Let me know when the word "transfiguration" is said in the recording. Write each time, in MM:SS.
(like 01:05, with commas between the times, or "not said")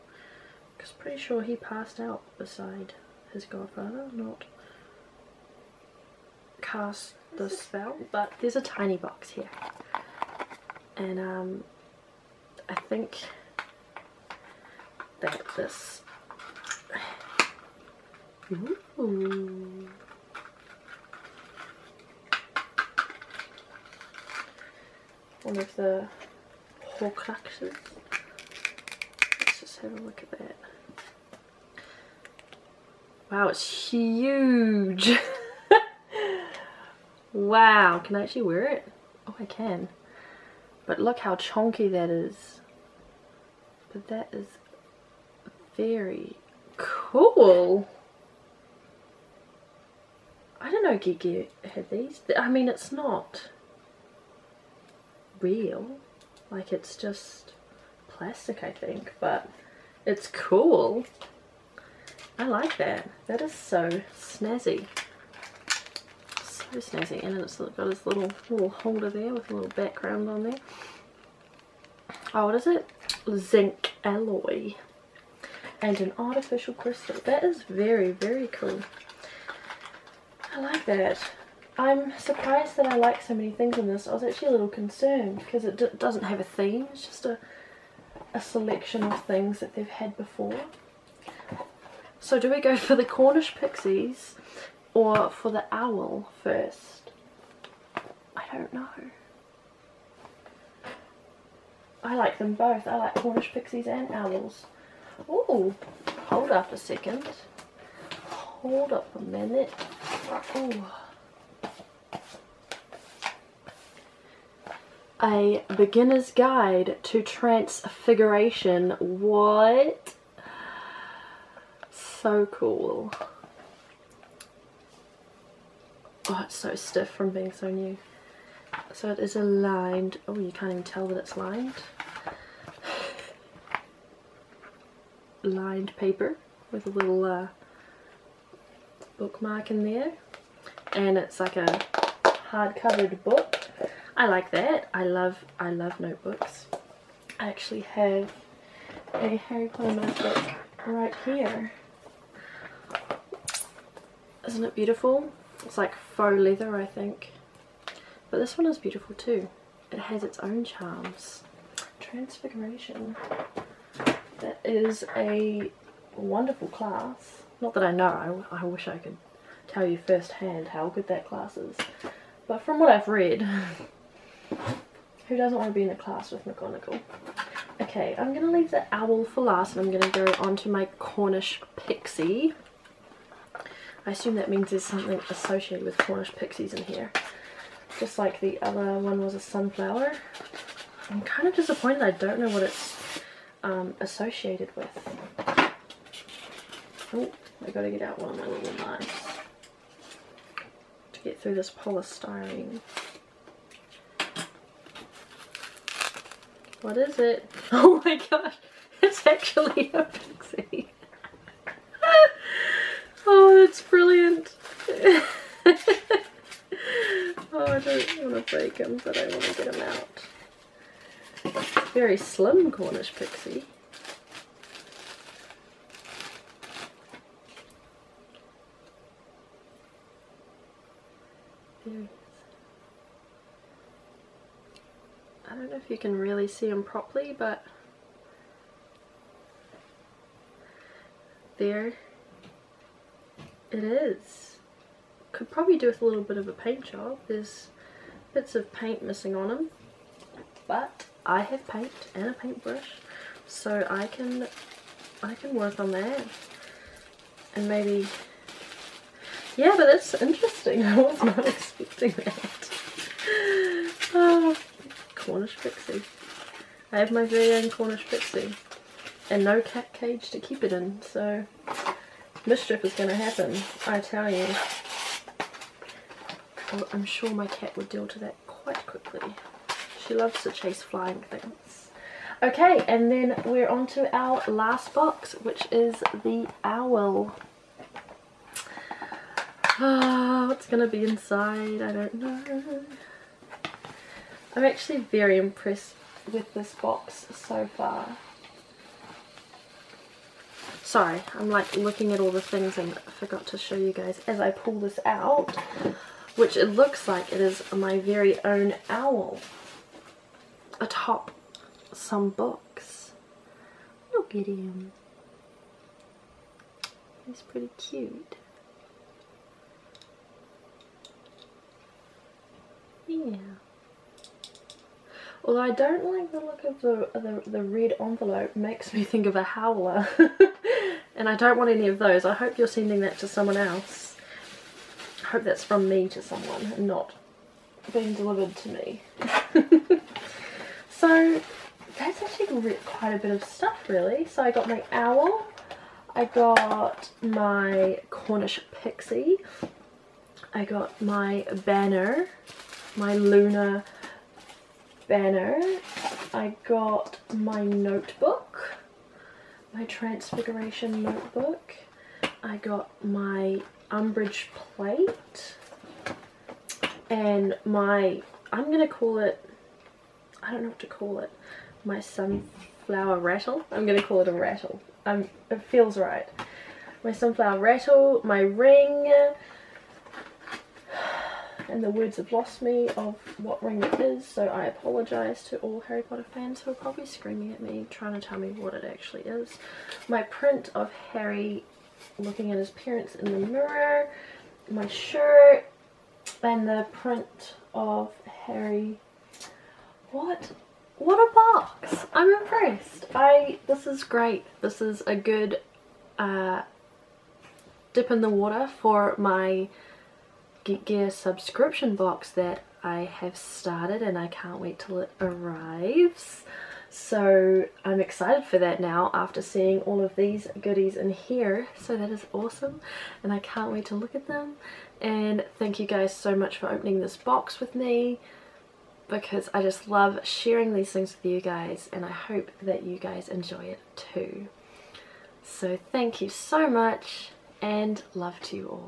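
01:57, 02:41, 05:59.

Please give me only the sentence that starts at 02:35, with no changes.
It's like faux leather I think.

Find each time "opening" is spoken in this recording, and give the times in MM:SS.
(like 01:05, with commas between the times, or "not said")
07:06.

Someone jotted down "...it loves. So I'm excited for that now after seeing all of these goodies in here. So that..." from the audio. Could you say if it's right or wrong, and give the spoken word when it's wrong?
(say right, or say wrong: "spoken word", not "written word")
wrong: "arrives", not "loves".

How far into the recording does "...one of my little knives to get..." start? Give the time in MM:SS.
03:18.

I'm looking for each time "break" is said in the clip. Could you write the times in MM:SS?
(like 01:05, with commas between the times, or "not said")
03:38.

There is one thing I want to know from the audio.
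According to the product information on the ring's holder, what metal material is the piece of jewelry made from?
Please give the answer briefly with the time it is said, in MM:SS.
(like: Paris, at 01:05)
Zinc alloy, at 01:13.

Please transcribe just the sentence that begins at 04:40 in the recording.
She loves to chase flying things.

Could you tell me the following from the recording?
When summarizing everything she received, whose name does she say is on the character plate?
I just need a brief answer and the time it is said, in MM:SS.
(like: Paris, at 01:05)
Umbridge, at 06:03.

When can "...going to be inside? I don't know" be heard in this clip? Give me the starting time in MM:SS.
04:50.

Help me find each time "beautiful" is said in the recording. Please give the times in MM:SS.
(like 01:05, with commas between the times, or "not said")
02:34, 02:38.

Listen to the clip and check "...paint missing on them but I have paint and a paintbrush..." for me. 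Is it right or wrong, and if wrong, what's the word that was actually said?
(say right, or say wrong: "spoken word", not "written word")
right.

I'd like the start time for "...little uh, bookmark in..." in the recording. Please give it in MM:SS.
02:16.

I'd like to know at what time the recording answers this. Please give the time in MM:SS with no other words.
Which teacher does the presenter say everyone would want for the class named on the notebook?
02:56.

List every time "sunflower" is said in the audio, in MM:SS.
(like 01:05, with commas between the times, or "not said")
03:09, 06:11, 06:17.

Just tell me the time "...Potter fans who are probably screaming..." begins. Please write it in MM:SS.
06:26.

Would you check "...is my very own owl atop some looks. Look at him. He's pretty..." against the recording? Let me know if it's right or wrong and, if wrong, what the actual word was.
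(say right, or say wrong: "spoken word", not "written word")
wrong: "books", not "looks".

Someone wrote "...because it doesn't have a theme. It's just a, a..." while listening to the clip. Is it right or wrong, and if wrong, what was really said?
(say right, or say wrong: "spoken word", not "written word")
right.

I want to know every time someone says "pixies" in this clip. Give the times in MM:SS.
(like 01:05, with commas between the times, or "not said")
01:33, 01:43, 03:01, 03:06, 03:30, 03:43, 04:28, 05:48.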